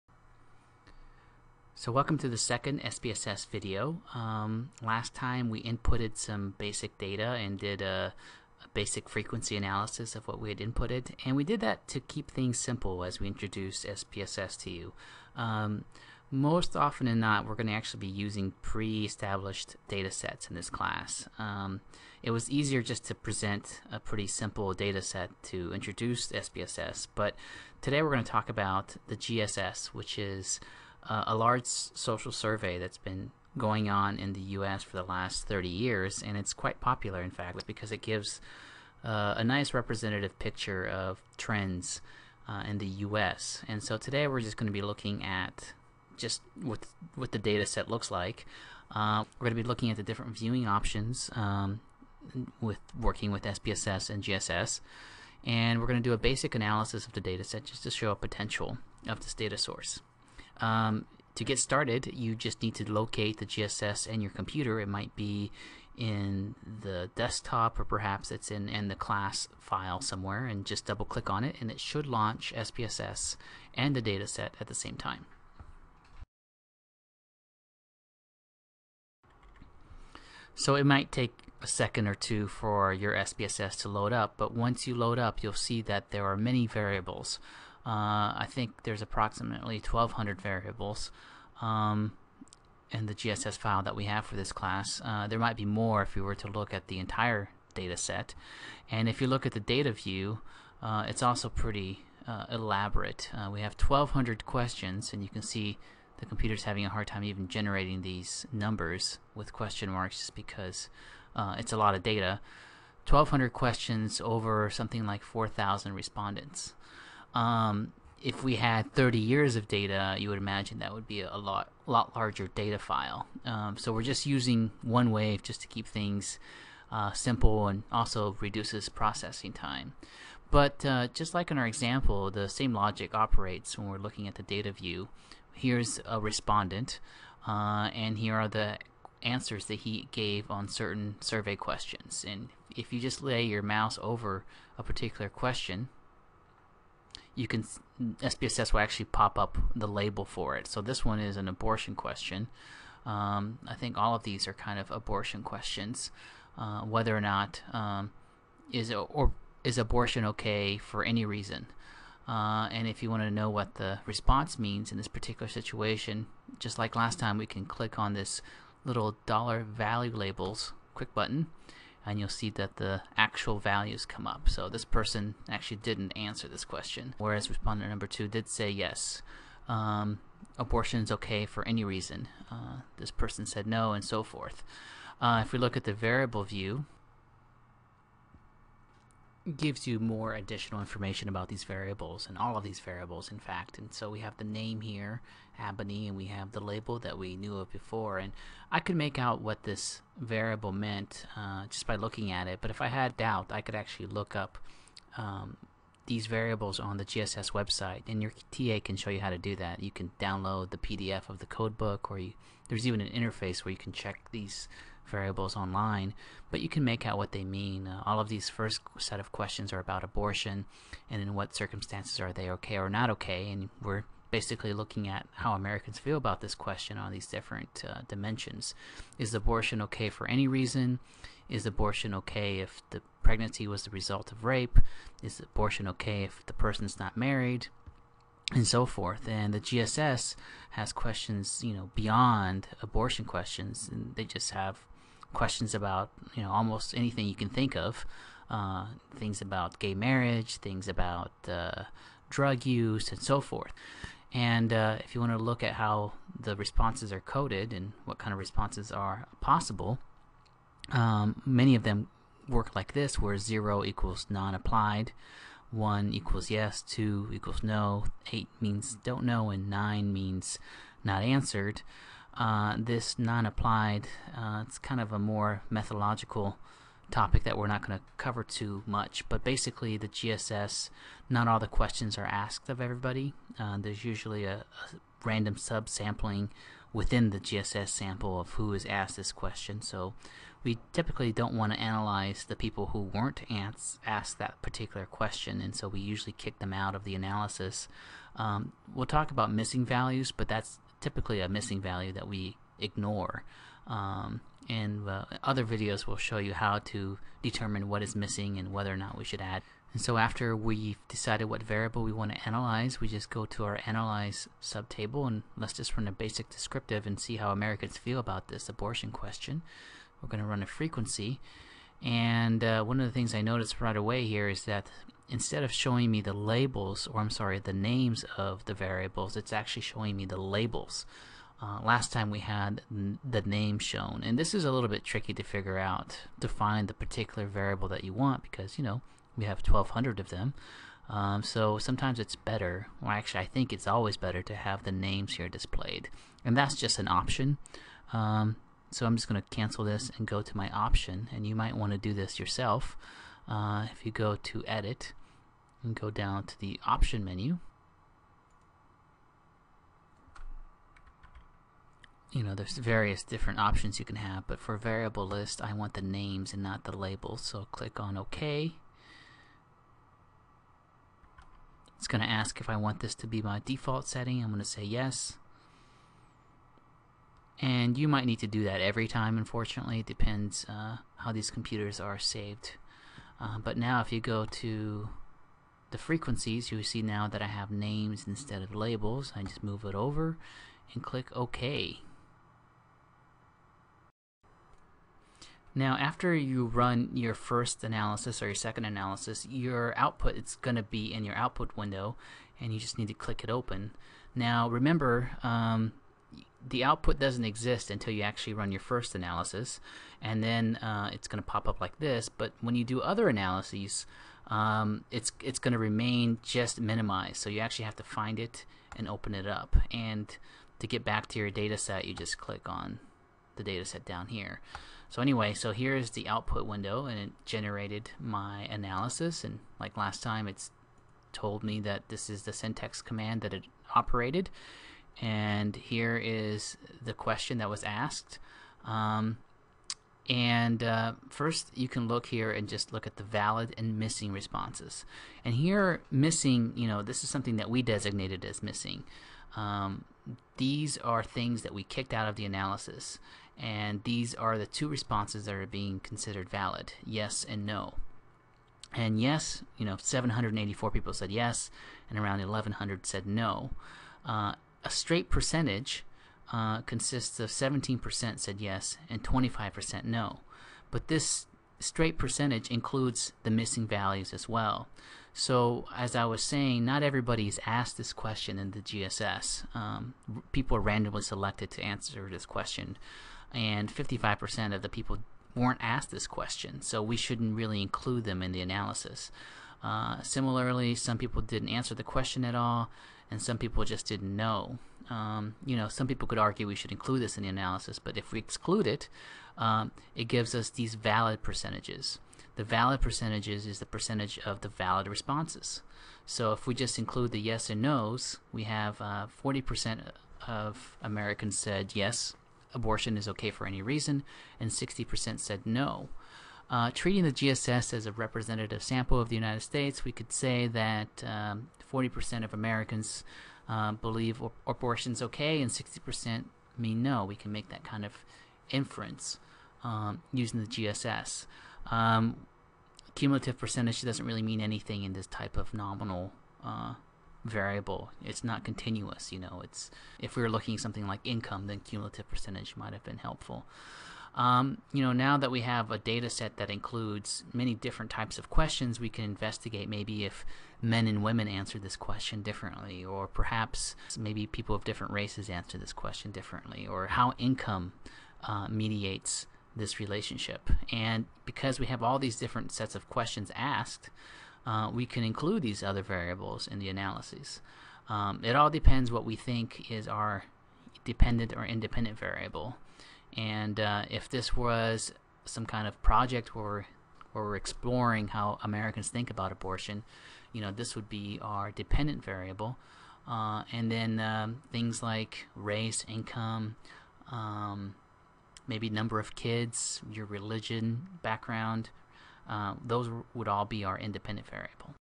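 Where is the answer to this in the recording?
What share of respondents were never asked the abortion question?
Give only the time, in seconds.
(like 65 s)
483 s.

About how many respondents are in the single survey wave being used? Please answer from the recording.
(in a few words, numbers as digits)
4,000.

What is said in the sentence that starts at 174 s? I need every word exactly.
So this person actually didn't answer this question, whereas respondent number two did say yes.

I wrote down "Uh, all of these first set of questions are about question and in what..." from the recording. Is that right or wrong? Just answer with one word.
wrong.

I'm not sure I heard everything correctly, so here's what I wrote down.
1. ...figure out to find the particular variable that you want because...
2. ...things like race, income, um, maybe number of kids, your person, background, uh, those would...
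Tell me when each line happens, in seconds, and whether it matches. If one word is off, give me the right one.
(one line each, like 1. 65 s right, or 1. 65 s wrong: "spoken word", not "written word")
1. 335 s right
2. 584 s wrong: "religion", not "person".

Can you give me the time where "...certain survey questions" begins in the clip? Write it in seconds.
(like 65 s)
140 s.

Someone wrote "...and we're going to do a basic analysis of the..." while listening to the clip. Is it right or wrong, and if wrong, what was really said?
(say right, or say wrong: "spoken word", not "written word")
right.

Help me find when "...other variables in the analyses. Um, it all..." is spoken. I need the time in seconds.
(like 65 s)
565 s.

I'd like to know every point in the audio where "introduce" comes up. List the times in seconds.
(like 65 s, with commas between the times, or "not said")
13 s, 25 s.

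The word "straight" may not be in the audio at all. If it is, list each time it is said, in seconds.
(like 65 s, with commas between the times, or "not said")
464 s, 471 s.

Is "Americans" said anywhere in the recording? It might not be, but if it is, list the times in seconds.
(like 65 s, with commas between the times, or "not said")
225 s, 317 s, 511 s, 522 s, 578 s.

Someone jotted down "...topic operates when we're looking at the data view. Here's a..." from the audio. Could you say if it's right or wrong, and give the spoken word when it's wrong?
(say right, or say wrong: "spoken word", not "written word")
wrong: "logic", not "topic".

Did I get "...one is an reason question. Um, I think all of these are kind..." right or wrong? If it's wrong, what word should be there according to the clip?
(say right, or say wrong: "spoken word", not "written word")
wrong: "abortion", not "reason".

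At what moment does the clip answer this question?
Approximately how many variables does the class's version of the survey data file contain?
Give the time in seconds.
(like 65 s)
89 s.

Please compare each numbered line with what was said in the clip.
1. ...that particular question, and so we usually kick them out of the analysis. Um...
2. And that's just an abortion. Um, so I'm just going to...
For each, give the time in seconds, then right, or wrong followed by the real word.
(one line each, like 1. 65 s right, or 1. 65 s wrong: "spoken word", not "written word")
1. 294 s right
2. 346 s wrong: "option", not "abortion".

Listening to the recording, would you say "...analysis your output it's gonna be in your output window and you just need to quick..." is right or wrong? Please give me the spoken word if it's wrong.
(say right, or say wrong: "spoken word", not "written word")
wrong: "click", not "quick".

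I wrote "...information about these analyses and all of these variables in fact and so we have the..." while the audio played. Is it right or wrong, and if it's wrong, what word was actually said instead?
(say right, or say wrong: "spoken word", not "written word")
wrong: "variables", not "analyses".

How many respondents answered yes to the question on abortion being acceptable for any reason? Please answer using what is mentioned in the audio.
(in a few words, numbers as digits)
784.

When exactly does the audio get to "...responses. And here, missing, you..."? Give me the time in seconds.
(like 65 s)
444 s.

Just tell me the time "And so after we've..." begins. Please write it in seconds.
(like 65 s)
309 s.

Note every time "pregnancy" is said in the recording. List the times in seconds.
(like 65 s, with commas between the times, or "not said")
233 s.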